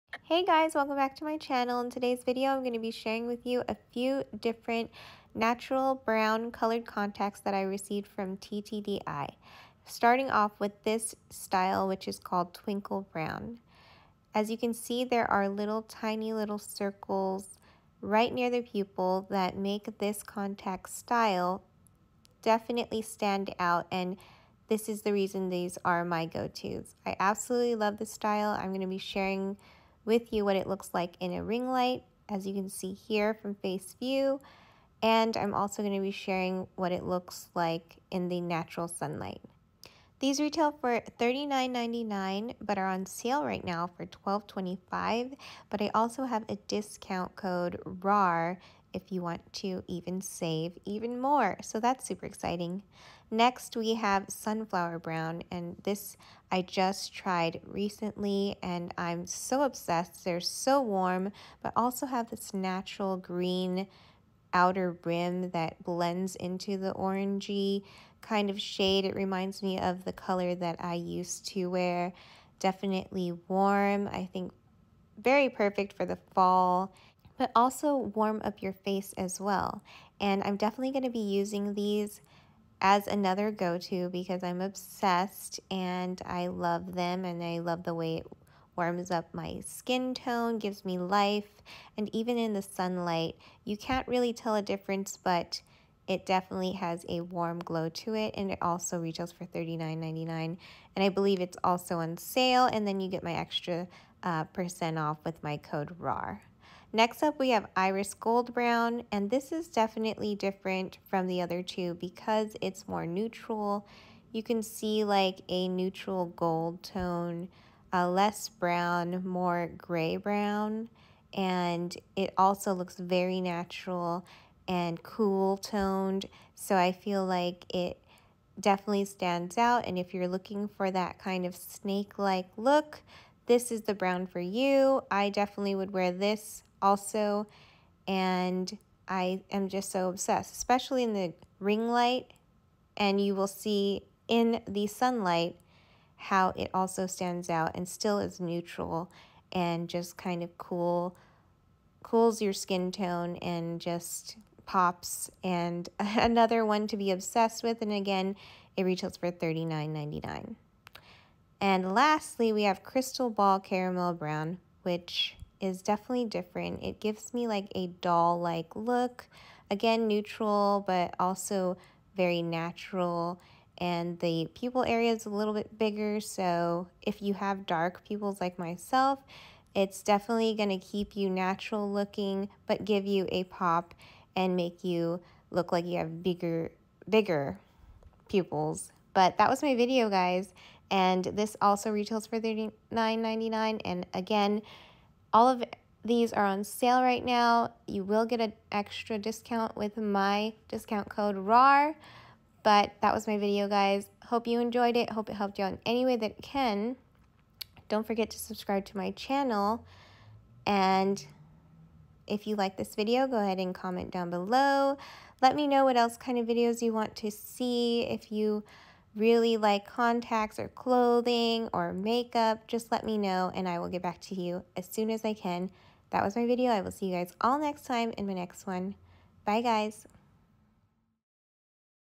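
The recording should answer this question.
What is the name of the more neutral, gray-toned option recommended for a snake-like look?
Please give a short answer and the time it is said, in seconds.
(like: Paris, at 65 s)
Iris Gold Brown, at 107 s.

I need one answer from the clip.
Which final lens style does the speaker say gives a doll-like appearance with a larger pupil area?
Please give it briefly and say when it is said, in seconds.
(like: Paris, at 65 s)
Crystal Ball Caramel Brown, at 162 s.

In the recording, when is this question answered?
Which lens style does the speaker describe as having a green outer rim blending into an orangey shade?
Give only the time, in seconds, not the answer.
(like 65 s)
54 s.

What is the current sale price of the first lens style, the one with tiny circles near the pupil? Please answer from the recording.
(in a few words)
$12.25.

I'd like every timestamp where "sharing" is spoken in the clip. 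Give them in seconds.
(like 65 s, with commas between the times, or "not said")
2 s, 28 s, 36 s.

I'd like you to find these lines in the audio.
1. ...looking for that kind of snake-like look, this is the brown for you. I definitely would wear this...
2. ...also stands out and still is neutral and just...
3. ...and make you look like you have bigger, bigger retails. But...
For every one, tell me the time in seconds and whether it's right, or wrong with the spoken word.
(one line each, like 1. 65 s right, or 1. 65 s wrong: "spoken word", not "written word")
1. 130 s right
2. 146 s right
3. 184 s wrong: "pupils", not "retails".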